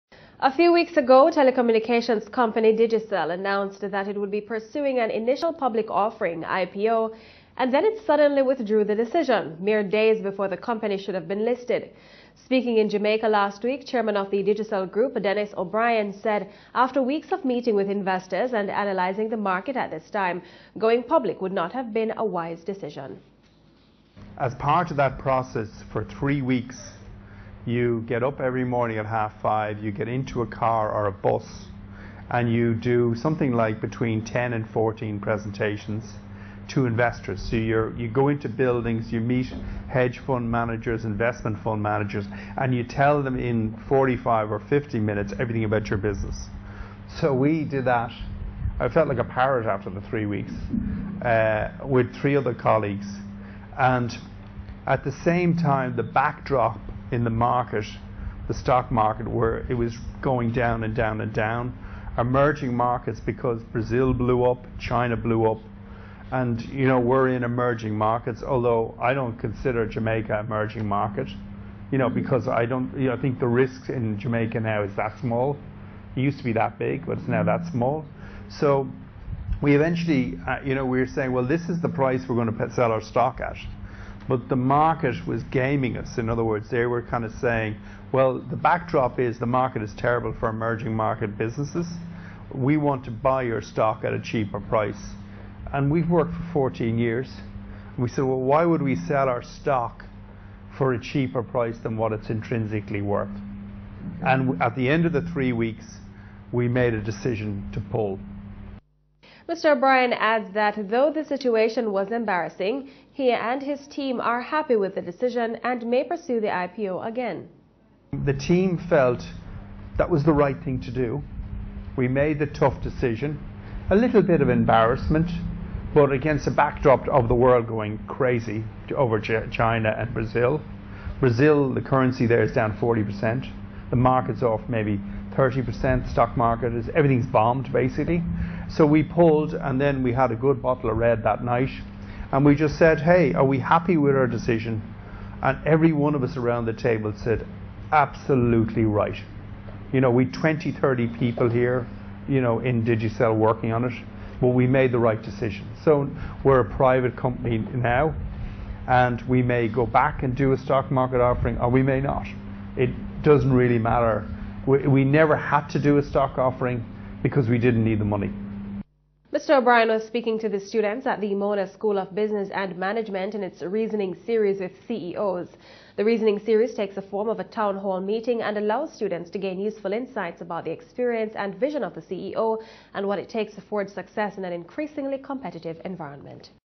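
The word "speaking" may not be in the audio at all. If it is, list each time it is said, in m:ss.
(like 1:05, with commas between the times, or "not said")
0:12, 2:50.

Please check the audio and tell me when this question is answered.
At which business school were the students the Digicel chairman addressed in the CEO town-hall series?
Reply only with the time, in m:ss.
2:51.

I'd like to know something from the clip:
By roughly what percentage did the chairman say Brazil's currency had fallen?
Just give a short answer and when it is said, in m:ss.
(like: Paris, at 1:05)
40%, at 2:12.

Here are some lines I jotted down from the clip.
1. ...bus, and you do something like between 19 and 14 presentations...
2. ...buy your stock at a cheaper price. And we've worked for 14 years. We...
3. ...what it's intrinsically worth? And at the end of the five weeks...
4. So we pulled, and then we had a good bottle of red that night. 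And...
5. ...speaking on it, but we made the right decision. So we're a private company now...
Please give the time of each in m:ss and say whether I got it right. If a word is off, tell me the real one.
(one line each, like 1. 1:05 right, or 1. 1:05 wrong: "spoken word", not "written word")
1. 0:31 wrong: "10", not "19"
2. 1:33 right
3. 1:41 wrong: "three", not "five"
4. 2:18 right
5. 2:33 wrong: "working", not "speaking".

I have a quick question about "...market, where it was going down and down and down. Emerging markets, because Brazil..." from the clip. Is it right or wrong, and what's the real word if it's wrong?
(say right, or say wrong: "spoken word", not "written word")
right.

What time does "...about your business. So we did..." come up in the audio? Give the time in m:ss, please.
0:45.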